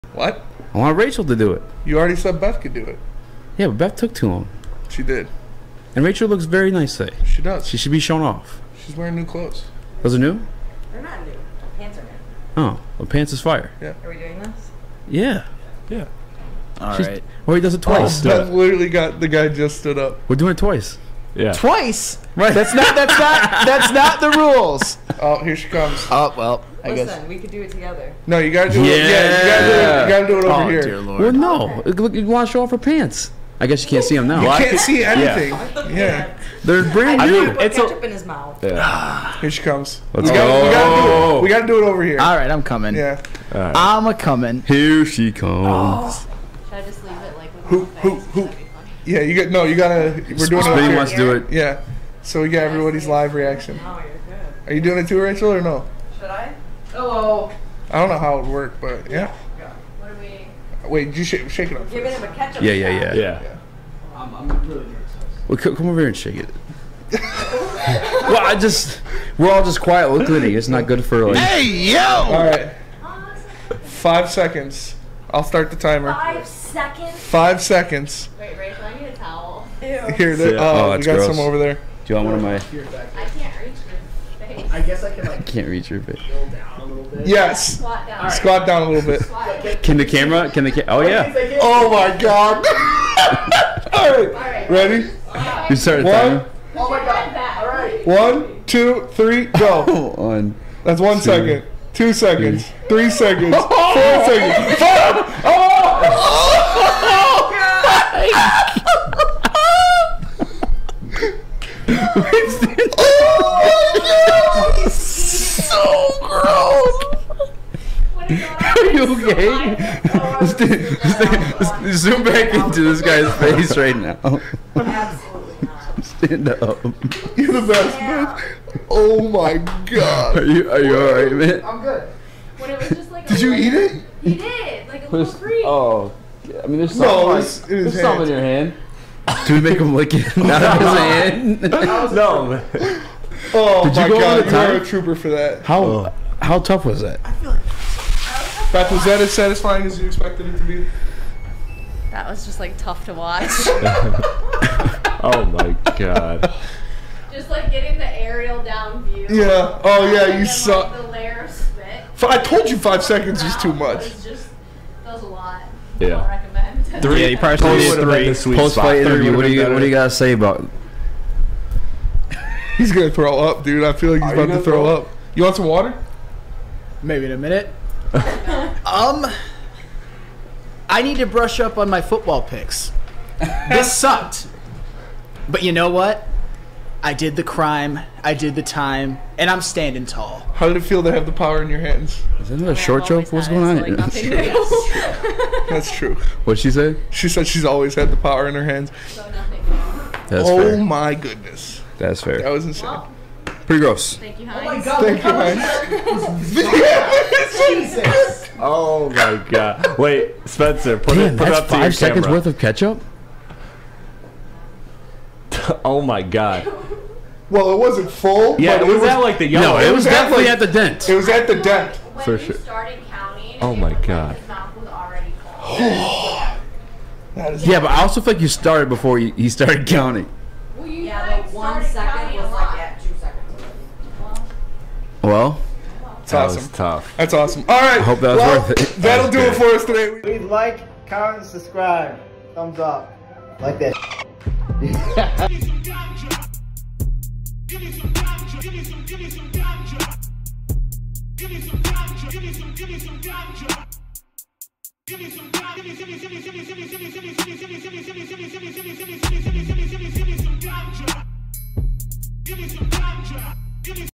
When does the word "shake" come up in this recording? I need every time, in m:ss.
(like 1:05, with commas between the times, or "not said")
1:01, 1:06.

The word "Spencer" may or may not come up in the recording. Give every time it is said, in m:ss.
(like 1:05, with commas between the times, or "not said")
3:30.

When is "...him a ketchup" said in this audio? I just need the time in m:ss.
1:02.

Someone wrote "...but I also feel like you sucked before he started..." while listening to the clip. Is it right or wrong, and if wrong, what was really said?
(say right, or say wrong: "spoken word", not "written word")
wrong: "started", not "sucked".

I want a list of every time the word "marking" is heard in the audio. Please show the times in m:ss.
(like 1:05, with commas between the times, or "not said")
not said.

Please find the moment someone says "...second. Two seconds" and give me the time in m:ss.
1:41.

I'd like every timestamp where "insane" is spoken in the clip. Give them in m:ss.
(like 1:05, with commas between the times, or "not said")
3:22.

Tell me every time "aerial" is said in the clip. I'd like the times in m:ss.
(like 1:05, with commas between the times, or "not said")
2:38.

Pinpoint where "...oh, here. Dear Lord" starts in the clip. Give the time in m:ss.
0:30.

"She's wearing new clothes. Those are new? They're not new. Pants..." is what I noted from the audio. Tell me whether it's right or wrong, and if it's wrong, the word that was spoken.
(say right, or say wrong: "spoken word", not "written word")
right.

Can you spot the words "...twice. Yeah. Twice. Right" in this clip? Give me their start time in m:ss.
0:20.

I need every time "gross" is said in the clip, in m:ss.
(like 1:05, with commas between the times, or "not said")
1:21, 3:23.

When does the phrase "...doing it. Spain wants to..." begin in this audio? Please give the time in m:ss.
0:50.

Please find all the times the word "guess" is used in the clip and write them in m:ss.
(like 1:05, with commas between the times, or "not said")
0:27, 0:33, 1:24.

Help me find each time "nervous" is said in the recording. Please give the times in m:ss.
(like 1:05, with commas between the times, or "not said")
1:04.